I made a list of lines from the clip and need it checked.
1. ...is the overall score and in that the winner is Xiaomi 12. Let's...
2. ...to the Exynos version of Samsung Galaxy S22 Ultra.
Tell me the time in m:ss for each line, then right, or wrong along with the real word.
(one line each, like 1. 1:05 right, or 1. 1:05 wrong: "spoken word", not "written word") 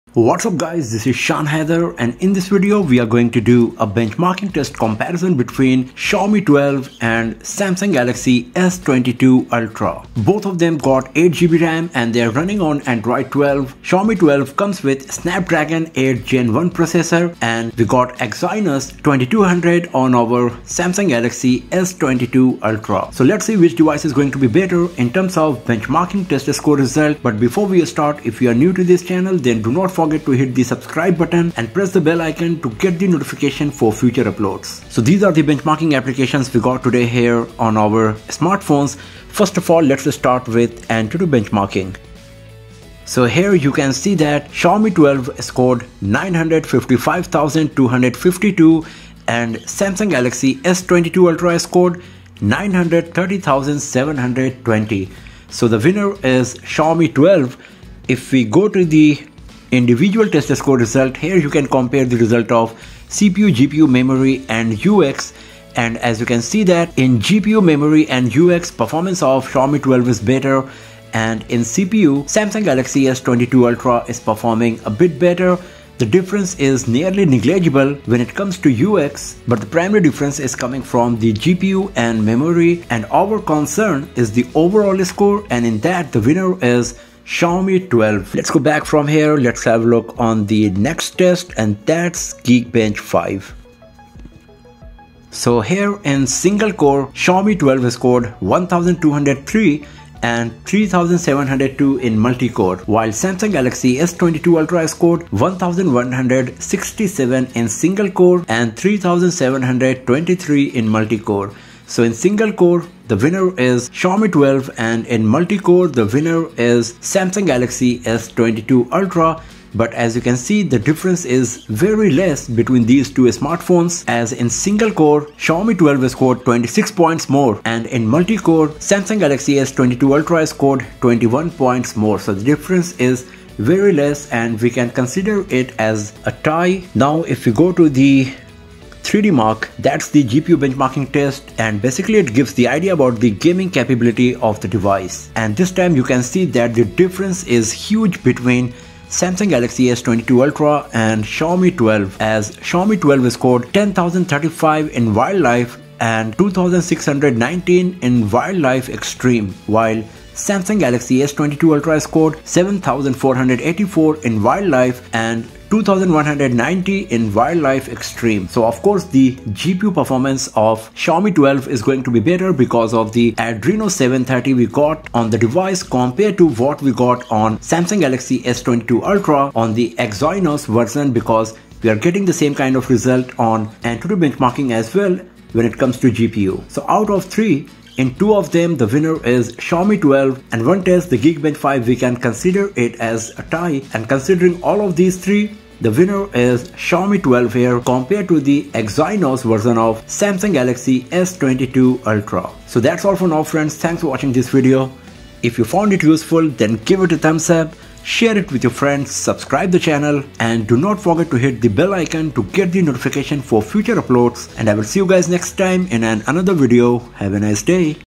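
1. 1:24 right
2. 3:18 right.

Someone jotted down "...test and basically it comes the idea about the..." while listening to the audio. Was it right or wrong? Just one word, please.
wrong.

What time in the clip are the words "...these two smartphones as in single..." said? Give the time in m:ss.
2:02.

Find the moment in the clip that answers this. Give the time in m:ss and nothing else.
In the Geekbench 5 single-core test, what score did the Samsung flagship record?
1:45.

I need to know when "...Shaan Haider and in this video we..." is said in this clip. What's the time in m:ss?
0:01.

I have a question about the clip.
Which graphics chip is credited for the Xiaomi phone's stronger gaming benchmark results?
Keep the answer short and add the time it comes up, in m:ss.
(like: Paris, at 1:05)
Adreno 730, at 2:53.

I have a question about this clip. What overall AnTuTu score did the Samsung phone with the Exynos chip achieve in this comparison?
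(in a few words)
930,720.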